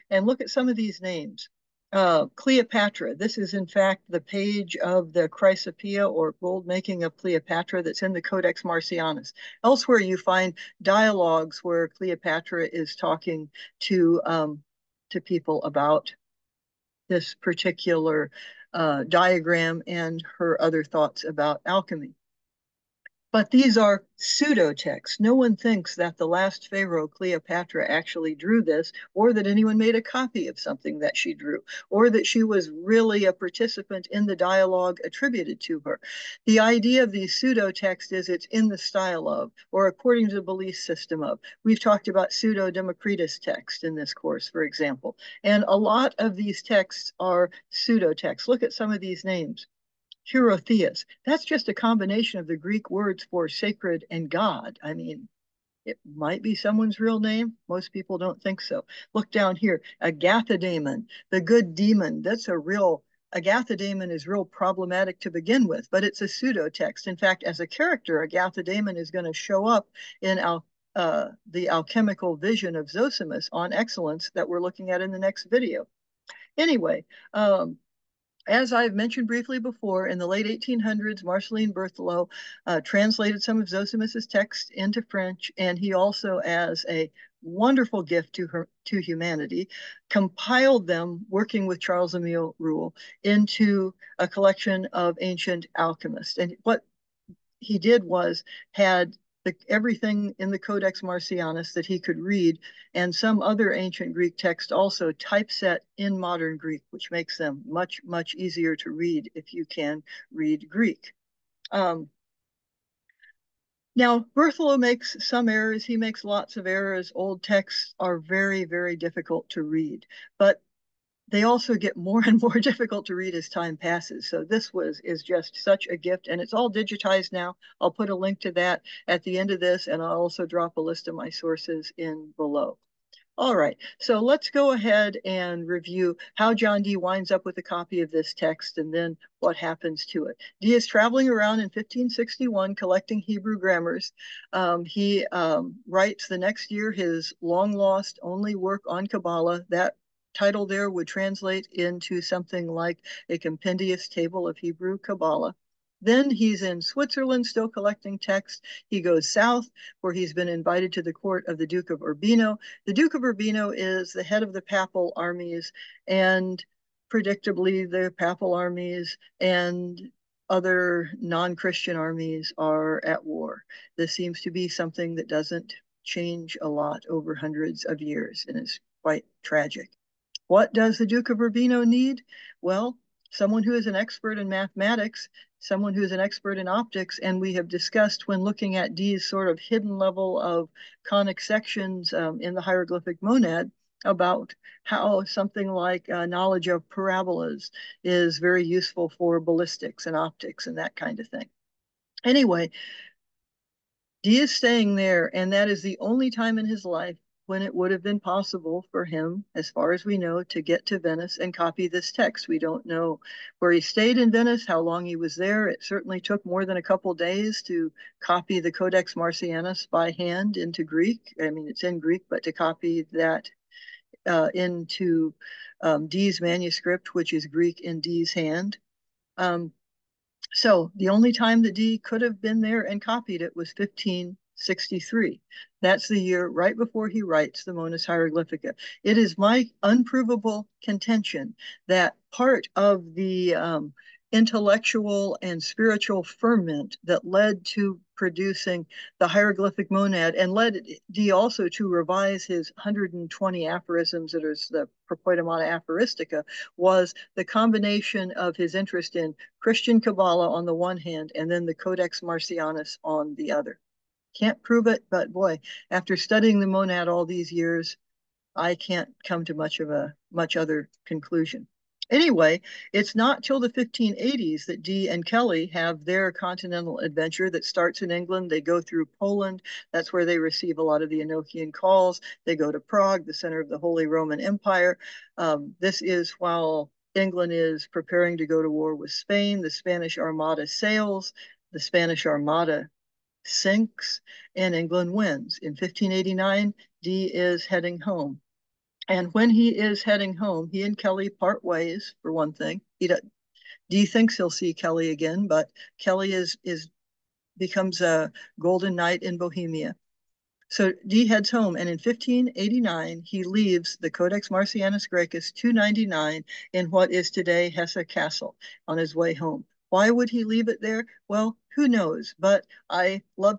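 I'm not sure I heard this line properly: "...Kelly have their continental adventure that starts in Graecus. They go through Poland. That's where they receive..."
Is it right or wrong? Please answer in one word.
wrong.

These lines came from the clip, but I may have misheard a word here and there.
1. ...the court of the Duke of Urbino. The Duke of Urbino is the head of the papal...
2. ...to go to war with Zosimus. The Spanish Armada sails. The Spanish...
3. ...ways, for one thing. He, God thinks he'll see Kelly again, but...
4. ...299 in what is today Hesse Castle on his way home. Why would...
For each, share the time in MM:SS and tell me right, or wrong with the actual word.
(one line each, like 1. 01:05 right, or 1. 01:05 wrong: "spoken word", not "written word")
1. 02:41 right
2. 04:48 wrong: "Spain", not "Zosimus"
3. 05:01 wrong: "Dee", not "God"
4. 05:15 right.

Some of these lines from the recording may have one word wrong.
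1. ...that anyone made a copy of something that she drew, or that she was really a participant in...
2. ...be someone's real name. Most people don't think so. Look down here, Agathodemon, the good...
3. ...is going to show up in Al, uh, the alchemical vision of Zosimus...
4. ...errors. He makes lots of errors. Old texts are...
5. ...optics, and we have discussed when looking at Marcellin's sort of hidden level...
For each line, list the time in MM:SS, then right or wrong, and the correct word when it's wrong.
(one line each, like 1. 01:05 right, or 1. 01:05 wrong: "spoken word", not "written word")
1. 00:29 right
2. 00:56 right
3. 01:08 right
4. 01:55 right
5. 03:06 wrong: "Dee", not "Marcellin".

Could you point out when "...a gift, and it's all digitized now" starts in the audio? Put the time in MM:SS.
02:05.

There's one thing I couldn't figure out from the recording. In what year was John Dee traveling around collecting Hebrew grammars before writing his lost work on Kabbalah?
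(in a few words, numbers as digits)
1561.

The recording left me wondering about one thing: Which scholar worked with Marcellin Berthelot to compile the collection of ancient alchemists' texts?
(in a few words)
Charles Emile Ruelle.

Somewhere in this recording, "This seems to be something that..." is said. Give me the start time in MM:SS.
02:53.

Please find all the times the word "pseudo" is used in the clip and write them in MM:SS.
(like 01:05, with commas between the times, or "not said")
00:24, 00:37, 00:42, 00:47, 01:06.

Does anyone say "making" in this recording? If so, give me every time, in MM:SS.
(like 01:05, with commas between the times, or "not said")
00:06.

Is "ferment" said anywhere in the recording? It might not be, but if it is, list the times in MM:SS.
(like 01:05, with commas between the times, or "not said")
04:06.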